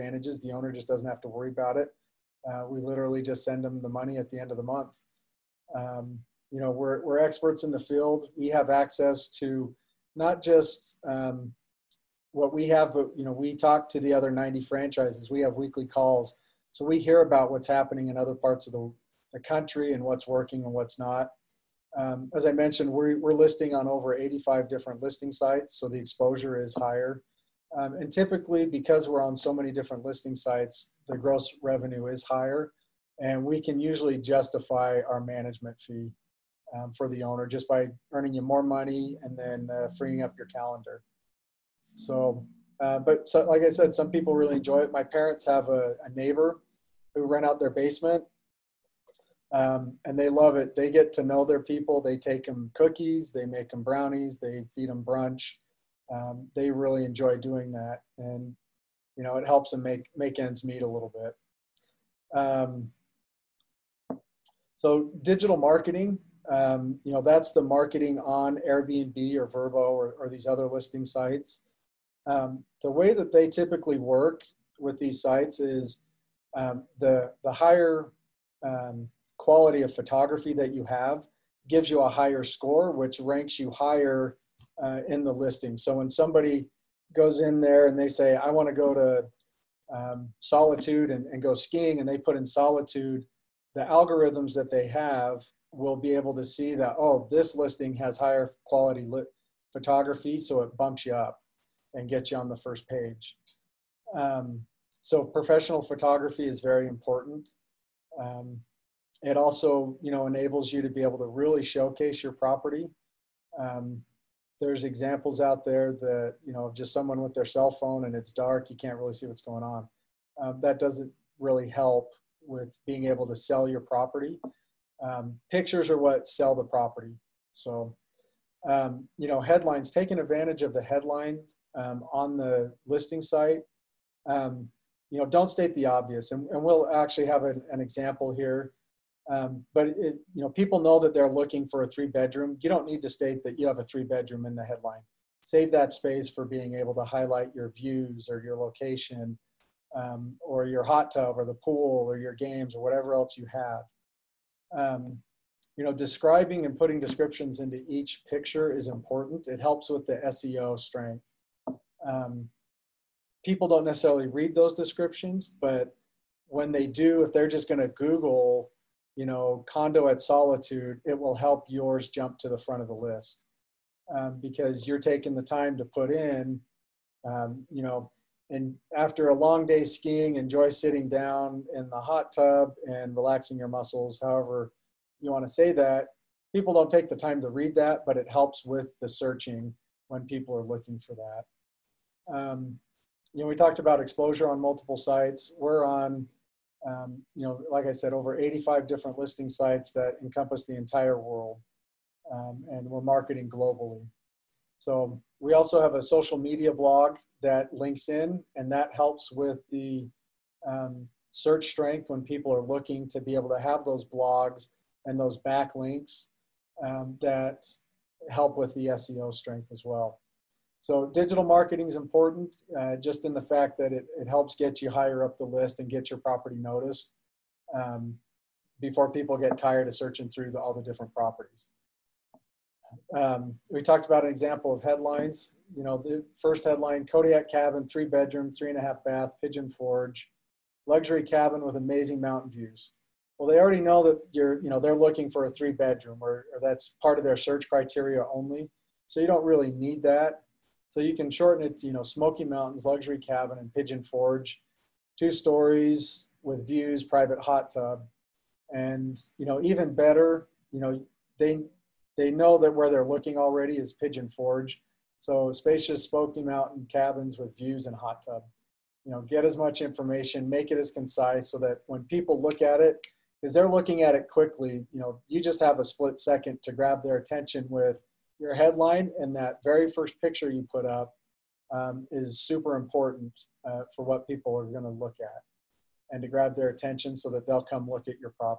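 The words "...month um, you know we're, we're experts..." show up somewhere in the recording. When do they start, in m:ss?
0:04.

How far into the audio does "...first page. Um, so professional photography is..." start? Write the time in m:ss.
1:42.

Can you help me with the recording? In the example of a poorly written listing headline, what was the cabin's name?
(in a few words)
Kodiak cabin.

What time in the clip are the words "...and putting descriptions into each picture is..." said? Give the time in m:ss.
2:36.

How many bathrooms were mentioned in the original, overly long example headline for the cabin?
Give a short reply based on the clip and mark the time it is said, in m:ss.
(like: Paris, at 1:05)
3.5, at 3:58.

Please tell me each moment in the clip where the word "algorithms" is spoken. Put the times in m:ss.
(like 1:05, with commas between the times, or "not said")
1:33.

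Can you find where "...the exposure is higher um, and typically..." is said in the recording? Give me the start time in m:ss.
0:25.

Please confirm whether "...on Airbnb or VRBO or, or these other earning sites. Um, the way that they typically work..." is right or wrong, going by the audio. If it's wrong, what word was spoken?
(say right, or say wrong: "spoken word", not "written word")
wrong: "listing", not "earning".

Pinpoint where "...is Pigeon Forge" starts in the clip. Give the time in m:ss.
4:23.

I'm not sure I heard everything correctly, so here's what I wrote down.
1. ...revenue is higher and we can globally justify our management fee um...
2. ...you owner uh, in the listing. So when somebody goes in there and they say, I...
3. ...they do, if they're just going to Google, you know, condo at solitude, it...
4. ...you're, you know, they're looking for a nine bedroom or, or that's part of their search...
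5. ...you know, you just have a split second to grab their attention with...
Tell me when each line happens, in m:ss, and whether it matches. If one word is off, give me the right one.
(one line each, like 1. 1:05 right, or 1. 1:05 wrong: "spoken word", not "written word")
1. 0:31 wrong: "usually", not "globally"
2. 1:23 wrong: "higher", not "owner"
3. 2:46 right
4. 4:04 wrong: "three", not "nine"
5. 4:34 right.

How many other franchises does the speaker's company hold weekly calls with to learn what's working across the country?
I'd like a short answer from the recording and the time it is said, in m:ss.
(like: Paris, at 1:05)
90, at 0:14.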